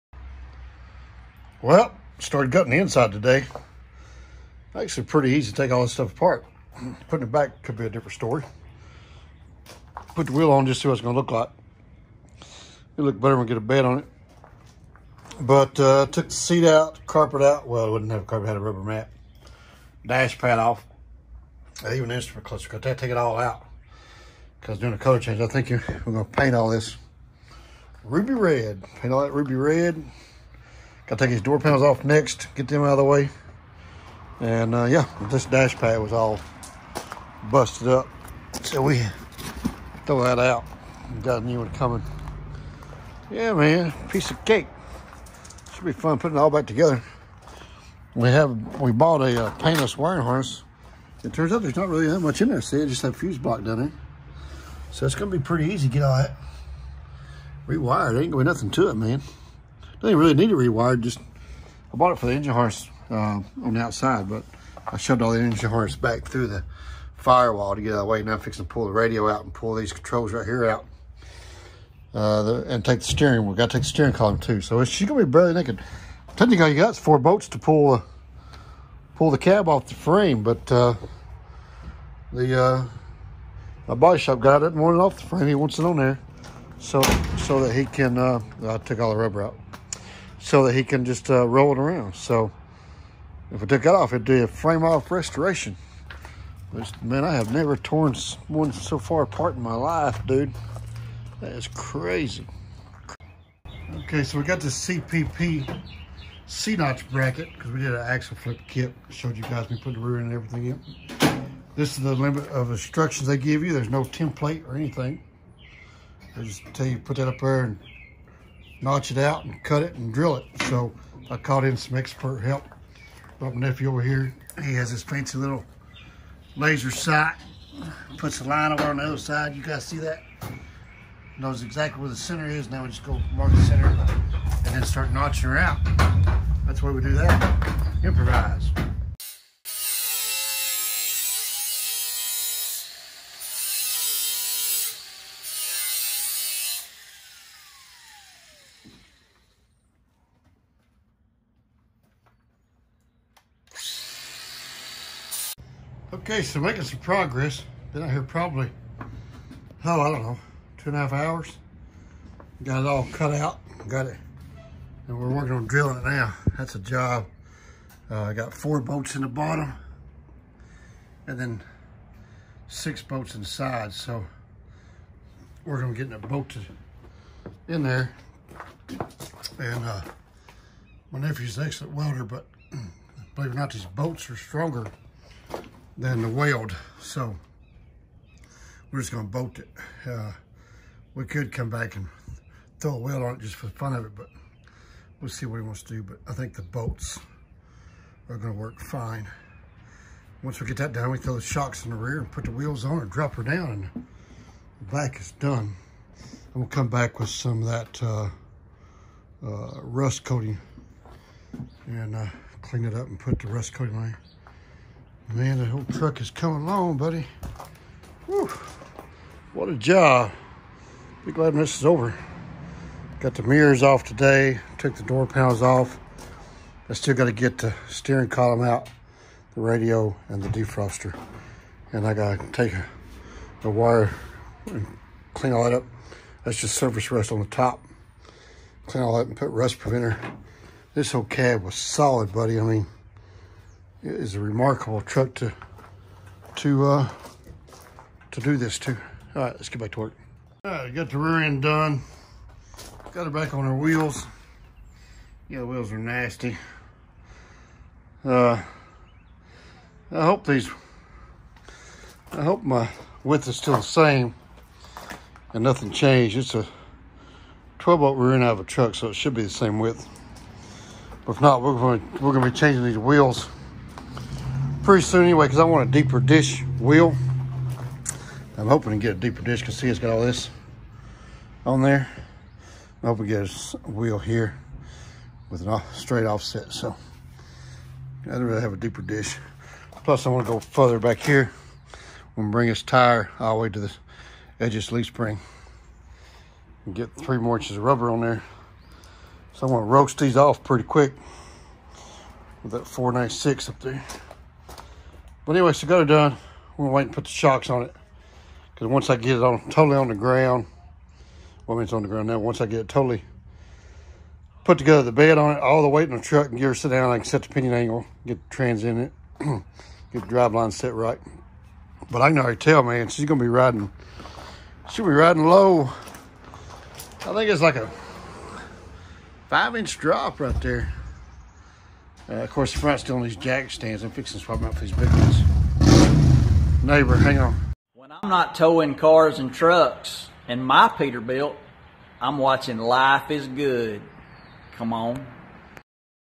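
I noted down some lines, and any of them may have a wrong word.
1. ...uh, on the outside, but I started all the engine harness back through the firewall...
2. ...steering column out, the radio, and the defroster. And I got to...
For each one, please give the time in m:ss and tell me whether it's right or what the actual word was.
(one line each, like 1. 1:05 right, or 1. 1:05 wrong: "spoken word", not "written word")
1. 1:03 wrong: "shoved", not "started"
2. 3:47 right.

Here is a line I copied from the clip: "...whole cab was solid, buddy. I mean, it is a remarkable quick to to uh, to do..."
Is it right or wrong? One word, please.
wrong.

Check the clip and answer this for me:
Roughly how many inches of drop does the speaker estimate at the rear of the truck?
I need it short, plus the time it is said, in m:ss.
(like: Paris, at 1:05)
5, at 5:29.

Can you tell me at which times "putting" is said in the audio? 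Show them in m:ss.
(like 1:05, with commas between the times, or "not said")
0:07, 0:46, 1:49.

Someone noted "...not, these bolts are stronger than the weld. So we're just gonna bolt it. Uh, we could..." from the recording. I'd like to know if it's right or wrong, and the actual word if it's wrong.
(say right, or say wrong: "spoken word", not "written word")
right.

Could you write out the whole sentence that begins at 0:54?
So it's gonna be pretty easy to get all that rewired.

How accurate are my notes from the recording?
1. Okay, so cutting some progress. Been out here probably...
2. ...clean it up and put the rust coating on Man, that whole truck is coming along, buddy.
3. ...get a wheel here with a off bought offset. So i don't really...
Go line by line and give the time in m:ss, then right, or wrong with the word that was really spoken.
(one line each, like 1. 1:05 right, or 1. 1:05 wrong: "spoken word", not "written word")
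1. 2:36 wrong: "making", not "cutting"
2. 3:32 right
3. 4:43 wrong: "straight", not "bought".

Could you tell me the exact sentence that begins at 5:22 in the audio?
But I can already tell, man, she's gonna be riding, she'll be riding low.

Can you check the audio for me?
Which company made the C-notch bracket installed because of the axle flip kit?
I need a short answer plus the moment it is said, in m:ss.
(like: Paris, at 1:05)
CPP, at 1:44.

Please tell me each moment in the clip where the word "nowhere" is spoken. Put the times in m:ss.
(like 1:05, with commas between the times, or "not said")
not said.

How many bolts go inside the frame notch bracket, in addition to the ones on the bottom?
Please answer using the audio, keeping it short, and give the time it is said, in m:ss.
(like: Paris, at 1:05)
6, at 2:52.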